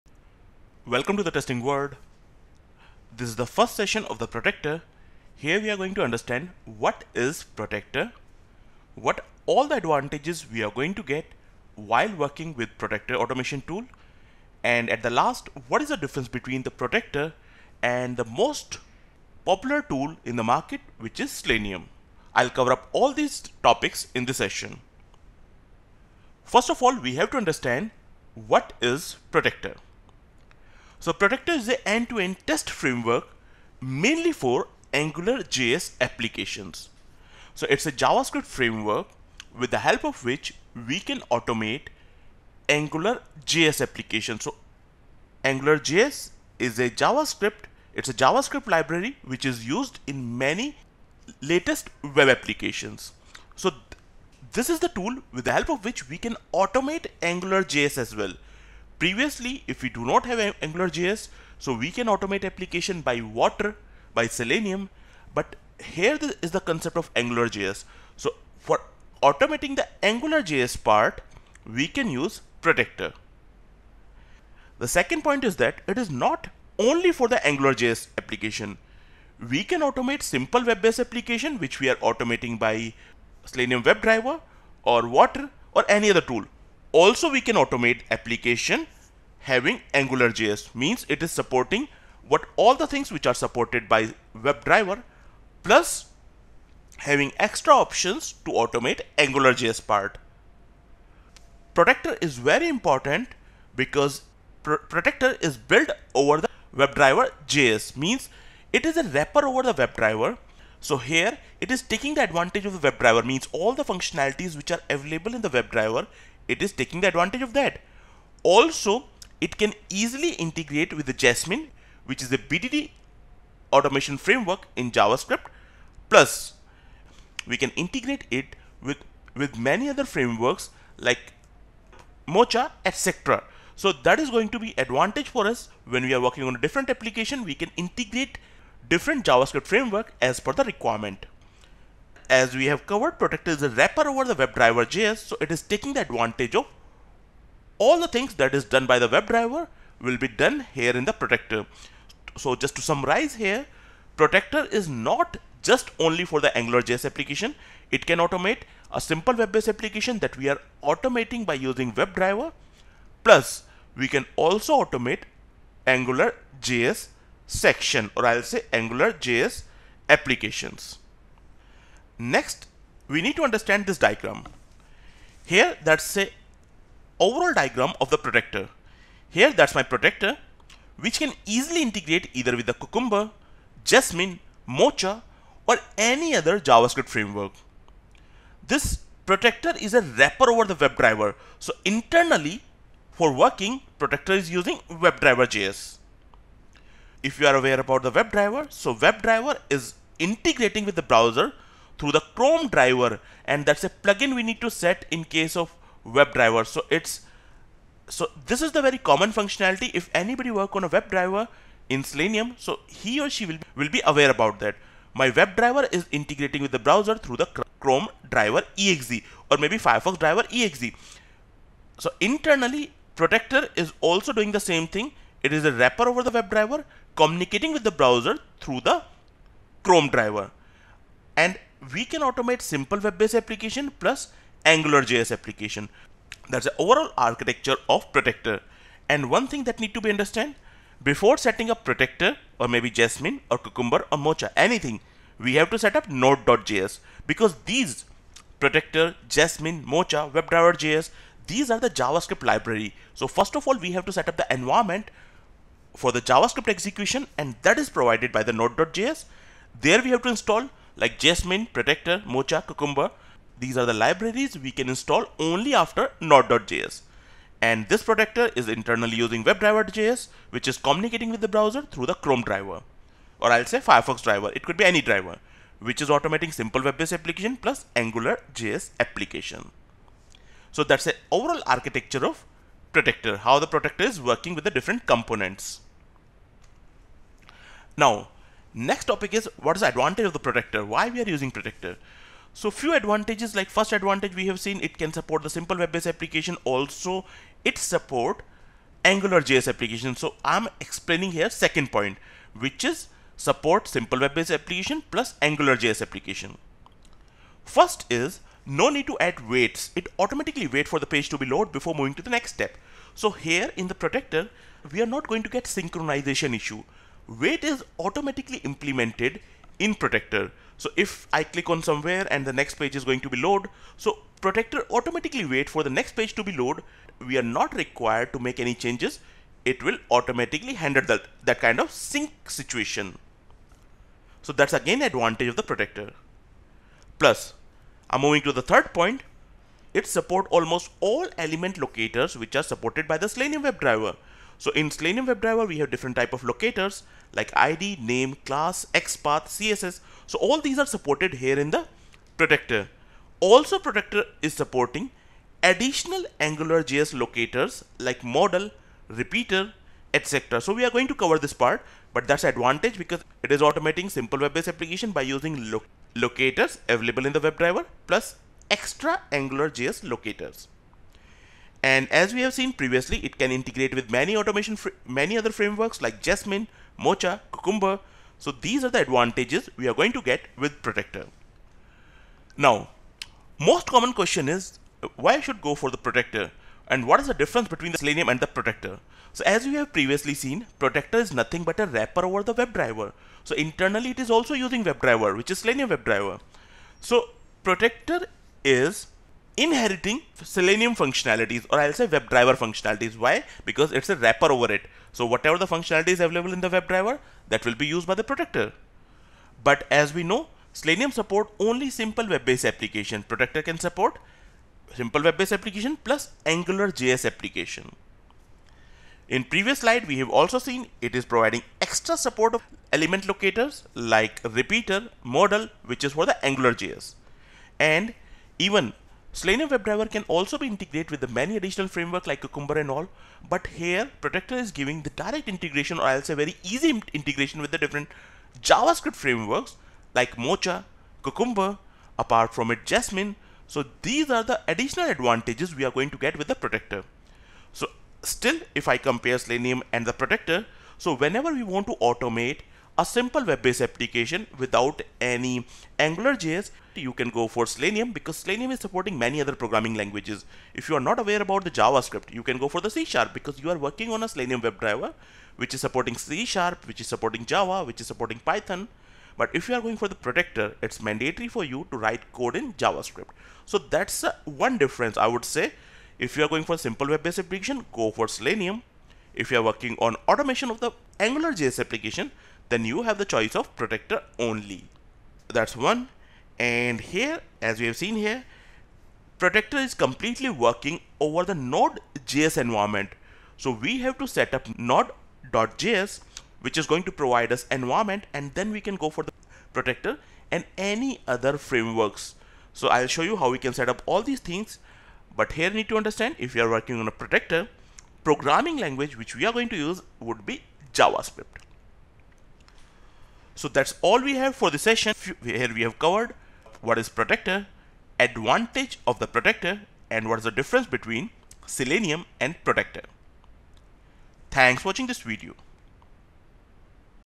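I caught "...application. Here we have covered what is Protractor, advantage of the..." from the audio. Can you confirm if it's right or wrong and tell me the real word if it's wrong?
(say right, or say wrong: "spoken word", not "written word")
wrong: "session", not "application".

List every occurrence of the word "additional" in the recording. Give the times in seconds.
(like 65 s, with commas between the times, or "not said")
355 s, 431 s, 444 s.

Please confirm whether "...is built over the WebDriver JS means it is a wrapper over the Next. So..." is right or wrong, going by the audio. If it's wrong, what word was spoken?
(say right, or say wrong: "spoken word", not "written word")
wrong: "WebDriver", not "Next".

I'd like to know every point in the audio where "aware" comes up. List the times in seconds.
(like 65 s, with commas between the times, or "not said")
197 s, 214 s, 461 s.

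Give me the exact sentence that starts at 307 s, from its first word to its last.
First is no need to add waits.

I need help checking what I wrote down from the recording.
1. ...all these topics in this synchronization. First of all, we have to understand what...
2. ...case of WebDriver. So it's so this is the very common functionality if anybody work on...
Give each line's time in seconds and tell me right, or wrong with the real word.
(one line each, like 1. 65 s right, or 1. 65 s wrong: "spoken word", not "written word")
1. 22 s wrong: "session", not "synchronization"
2. 205 s right.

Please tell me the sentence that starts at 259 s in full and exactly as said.
There we have to install like Jasmine, Protractor, Mocha, Cucumber.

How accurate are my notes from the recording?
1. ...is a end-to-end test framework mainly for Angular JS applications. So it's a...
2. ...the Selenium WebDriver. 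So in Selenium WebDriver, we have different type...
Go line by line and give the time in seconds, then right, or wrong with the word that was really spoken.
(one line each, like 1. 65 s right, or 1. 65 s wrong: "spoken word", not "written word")
1. 31 s right
2. 343 s right.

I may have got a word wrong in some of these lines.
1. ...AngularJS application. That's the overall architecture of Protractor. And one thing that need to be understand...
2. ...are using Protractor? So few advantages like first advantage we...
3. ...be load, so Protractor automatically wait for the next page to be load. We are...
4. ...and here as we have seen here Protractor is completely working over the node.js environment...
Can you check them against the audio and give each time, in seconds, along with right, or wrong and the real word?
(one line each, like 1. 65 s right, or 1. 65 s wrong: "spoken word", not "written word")
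1. 234 s right
2. 291 s right
3. 323 s right
4. 486 s right.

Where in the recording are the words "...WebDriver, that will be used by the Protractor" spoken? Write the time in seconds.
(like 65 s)
406 s.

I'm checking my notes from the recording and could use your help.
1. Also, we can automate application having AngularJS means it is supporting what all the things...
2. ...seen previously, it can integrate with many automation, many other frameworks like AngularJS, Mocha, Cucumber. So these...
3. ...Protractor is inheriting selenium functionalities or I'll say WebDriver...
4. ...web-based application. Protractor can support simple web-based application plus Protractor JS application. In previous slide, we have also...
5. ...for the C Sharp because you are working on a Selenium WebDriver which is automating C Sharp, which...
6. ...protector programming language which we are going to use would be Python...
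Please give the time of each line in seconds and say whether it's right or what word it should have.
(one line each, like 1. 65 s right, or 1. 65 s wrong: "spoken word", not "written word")
1. 86 s right
2. 372 s wrong: "Jasmine", not "AngularJS"
3. 397 s right
4. 412 s wrong: "Angular", not "Protractor"
5. 462 s wrong: "supporting", not "automating"
6. 507 s wrong: "JavaScript", not "Python".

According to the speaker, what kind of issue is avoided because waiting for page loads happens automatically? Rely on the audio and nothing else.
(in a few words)
synchronization issue.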